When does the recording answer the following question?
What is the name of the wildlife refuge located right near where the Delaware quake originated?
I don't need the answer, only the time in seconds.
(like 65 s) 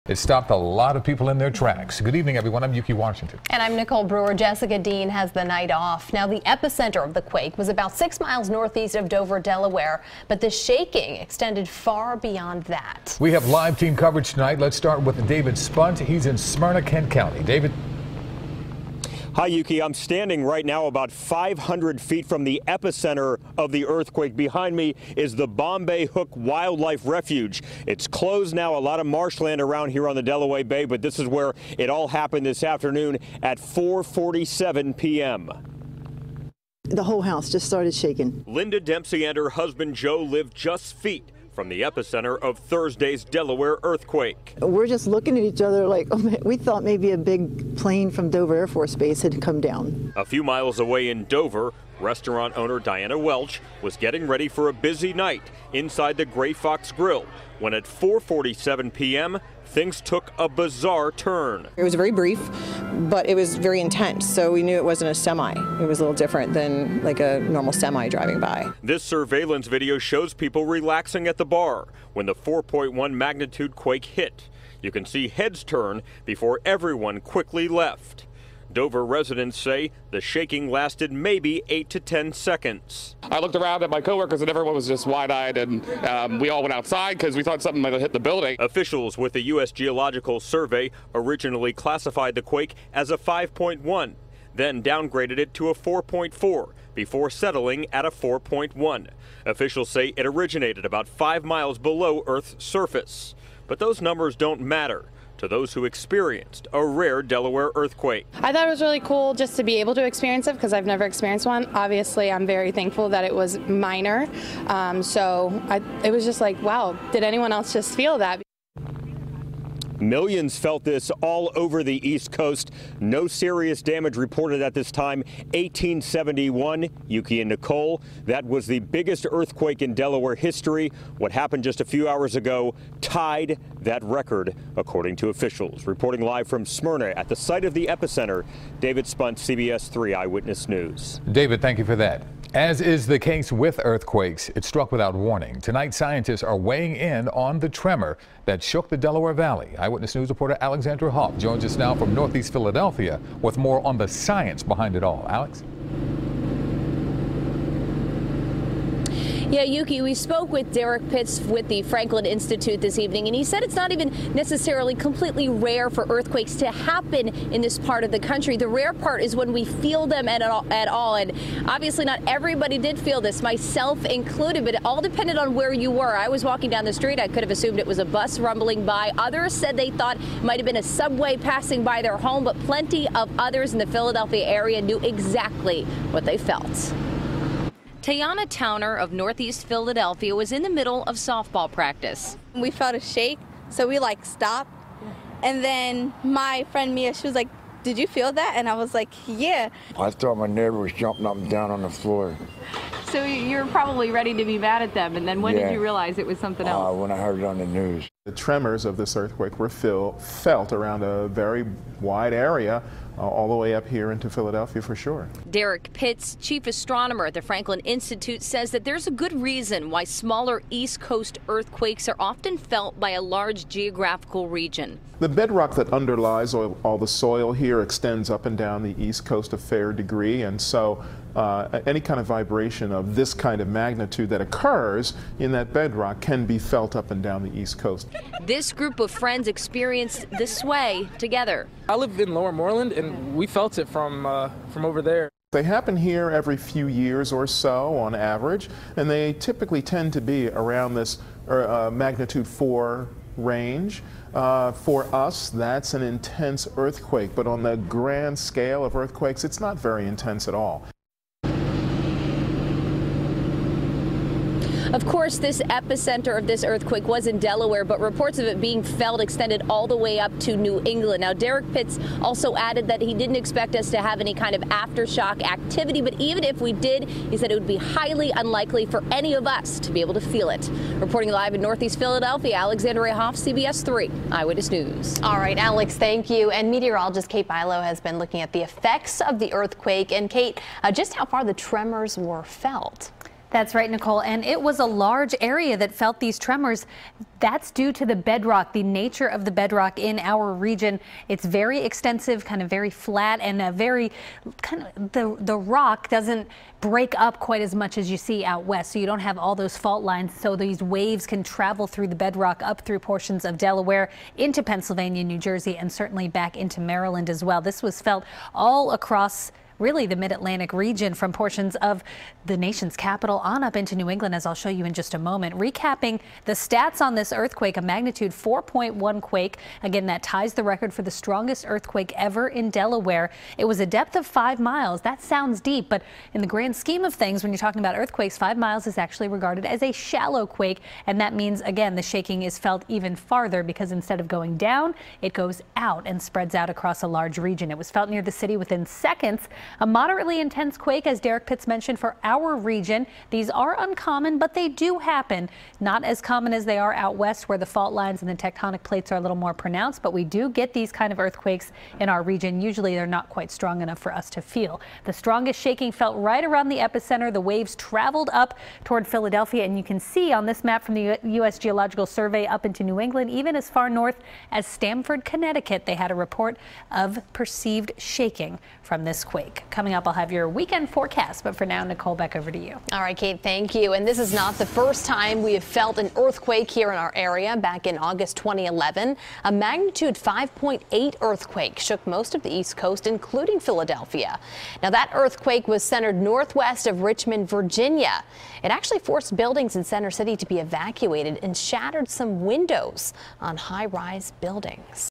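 25 s.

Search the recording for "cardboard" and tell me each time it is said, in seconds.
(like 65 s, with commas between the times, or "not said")
not said.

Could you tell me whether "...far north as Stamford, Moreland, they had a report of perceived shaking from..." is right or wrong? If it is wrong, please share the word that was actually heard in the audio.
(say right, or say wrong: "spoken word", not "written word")
wrong: "Connecticut", not "Moreland".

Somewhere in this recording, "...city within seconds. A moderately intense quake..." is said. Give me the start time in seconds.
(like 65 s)
348 s.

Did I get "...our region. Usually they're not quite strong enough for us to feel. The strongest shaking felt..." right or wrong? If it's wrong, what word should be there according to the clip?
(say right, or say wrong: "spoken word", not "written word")
right.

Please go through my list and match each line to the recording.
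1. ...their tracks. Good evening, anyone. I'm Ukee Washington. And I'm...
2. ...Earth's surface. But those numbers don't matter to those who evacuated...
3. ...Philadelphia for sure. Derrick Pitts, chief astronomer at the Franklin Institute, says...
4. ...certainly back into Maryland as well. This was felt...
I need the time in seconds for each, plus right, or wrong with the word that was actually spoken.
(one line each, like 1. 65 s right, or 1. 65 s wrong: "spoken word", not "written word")
1. 1 s wrong: "everyone", not "anyone"
2. 102 s wrong: "experienced", not "evacuated"
3. 214 s right
4. 315 s right.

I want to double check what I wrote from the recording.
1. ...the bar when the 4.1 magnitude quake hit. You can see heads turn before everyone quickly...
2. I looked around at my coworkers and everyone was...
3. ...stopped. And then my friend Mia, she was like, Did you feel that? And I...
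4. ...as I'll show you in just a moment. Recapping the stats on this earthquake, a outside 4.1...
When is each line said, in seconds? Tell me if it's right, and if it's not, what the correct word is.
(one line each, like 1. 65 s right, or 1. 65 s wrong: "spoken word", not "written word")
1. 71 s right
2. 83 s right
3. 194 s right
4. 324 s wrong: "magnitude", not "outside".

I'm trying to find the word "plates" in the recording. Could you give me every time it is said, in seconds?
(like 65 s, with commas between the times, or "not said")
358 s.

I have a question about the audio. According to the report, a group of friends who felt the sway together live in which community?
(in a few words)
Lower Moreland.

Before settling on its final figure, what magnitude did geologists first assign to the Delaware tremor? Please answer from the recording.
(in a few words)
5.1.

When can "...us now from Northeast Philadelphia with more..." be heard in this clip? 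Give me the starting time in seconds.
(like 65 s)
151 s.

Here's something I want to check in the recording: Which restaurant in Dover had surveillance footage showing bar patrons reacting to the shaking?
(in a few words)
Gray Fox Grill.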